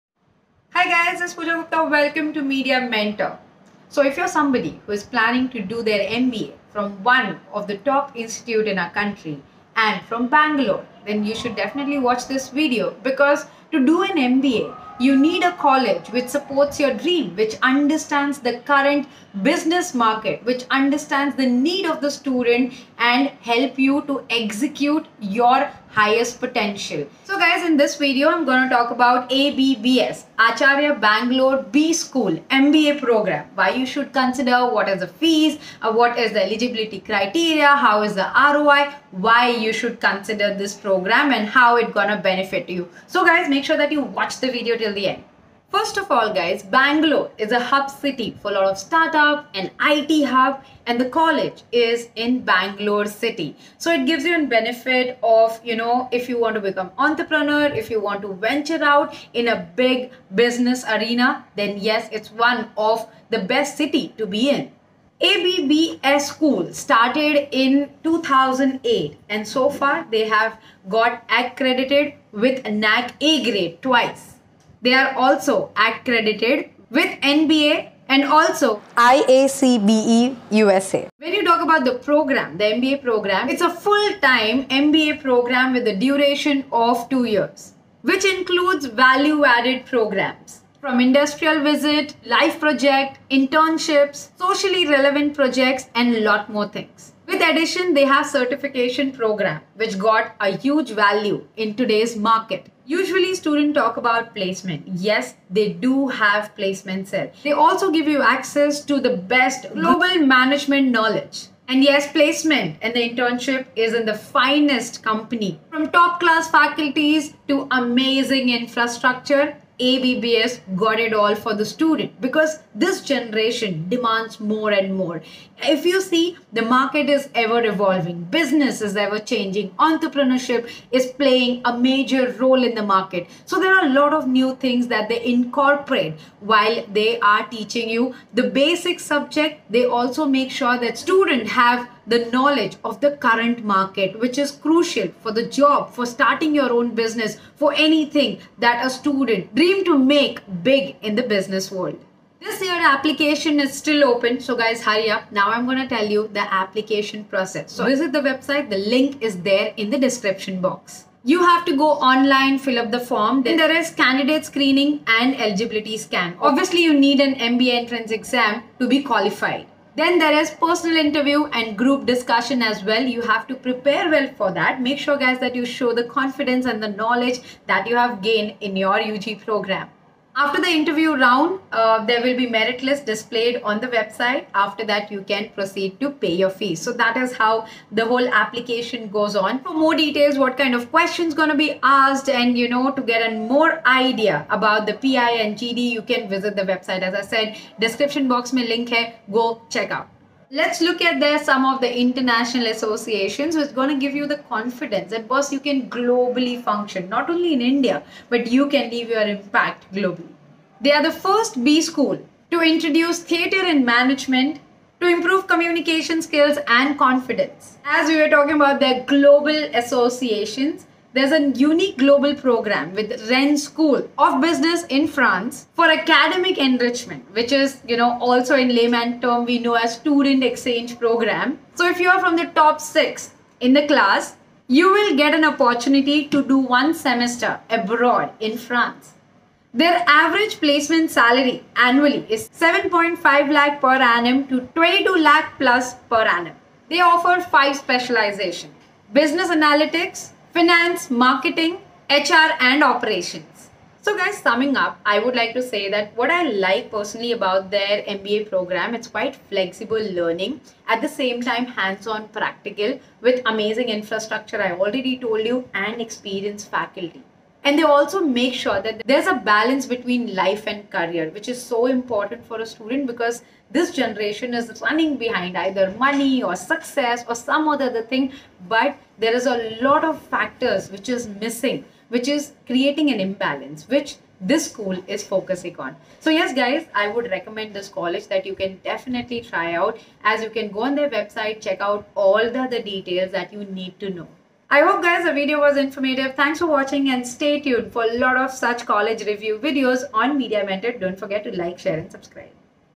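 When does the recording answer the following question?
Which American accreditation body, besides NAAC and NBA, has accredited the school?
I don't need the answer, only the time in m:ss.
1:18.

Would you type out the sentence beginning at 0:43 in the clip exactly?
So guys, make make sure that you watch the video till the end.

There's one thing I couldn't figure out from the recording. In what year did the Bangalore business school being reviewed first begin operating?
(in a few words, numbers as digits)
2008.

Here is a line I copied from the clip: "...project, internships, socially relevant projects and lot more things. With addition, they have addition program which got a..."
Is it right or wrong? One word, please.
wrong.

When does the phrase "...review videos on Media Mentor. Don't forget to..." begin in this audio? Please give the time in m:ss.
4:59.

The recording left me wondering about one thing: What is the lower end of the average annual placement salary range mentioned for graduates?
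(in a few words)
7.5 lakh per annum.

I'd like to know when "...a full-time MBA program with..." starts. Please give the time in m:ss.
1:23.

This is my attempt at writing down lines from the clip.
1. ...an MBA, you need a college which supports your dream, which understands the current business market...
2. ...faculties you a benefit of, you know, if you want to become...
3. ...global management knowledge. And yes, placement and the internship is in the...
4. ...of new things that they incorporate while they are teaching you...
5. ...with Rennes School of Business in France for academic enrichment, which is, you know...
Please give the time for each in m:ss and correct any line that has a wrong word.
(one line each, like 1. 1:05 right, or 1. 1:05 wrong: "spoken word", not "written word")
1. 0:14 right
2. 0:54 wrong: "gives", not "faculties"
3. 1:49 right
4. 2:14 right
5. 3:42 right.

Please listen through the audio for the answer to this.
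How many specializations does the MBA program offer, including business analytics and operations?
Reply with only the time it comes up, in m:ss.
4:07.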